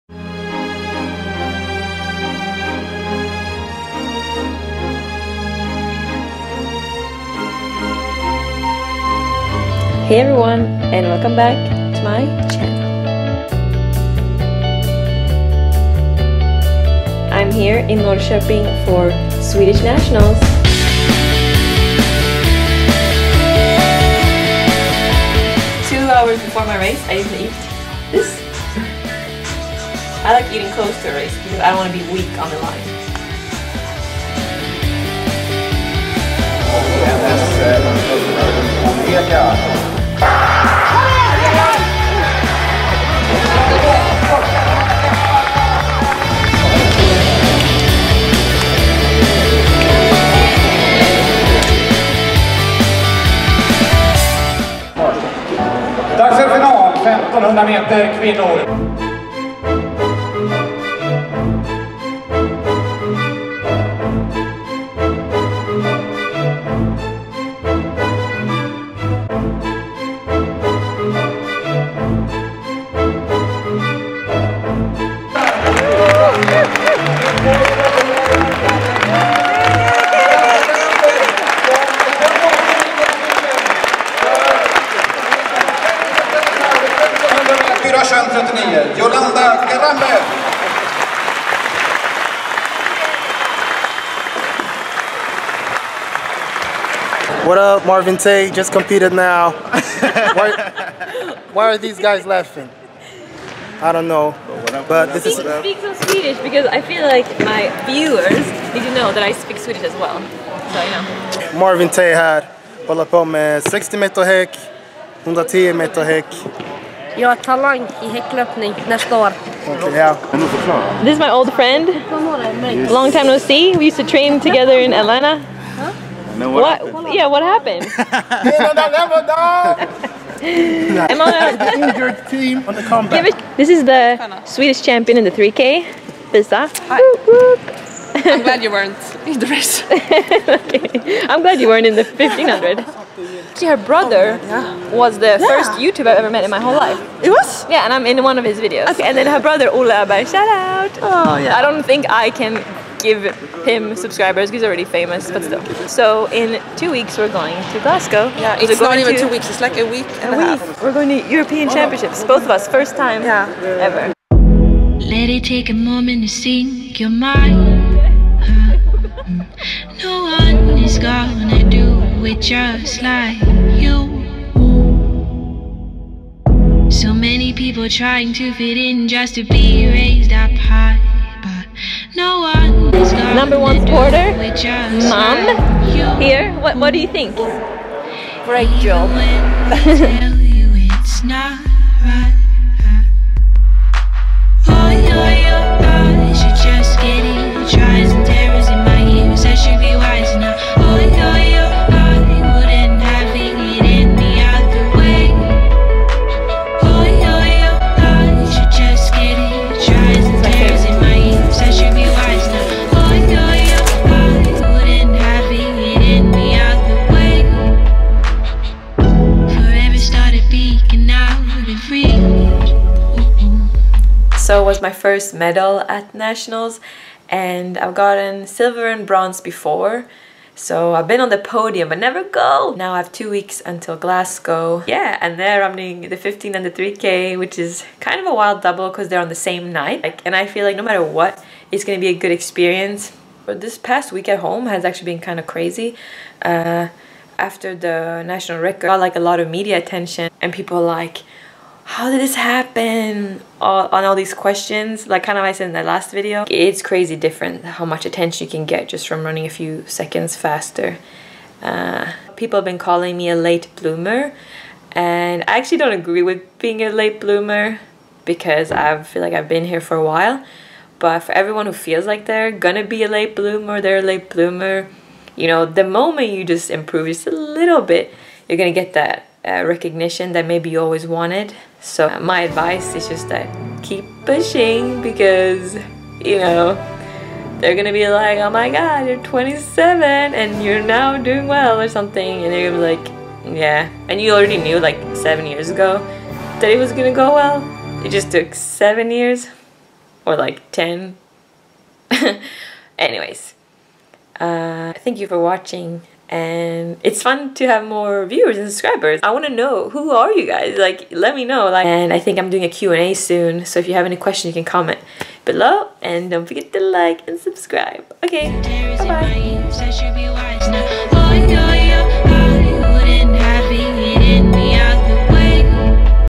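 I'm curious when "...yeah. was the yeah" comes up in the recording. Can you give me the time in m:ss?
2:24.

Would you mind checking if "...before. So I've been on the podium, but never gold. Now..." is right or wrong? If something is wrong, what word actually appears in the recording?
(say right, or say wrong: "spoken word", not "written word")
right.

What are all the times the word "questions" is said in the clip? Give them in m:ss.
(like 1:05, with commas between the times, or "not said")
4:14, 5:14.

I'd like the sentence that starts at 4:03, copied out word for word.
But this past week at home has actually been kind of crazy.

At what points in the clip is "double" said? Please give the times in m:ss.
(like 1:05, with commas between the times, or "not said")
3:58.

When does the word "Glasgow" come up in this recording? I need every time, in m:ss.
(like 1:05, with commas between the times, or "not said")
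2:37, 3:53.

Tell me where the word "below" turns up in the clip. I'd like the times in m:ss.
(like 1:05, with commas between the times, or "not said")
5:15.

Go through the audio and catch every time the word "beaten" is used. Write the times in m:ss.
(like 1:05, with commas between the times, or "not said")
not said.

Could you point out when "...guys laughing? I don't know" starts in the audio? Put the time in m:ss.
1:41.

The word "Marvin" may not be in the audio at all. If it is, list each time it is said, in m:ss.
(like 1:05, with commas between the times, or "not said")
1:37, 1:51.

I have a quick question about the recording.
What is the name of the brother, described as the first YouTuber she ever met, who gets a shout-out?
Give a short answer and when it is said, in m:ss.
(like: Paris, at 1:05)
Ola Abai, at 2:29.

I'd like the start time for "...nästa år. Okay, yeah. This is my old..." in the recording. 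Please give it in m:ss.
1:58.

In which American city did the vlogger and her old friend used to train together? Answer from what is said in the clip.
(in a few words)
Atlanta.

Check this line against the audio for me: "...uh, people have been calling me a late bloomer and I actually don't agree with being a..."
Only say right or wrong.
right.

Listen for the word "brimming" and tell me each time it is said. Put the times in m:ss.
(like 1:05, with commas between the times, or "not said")
not said.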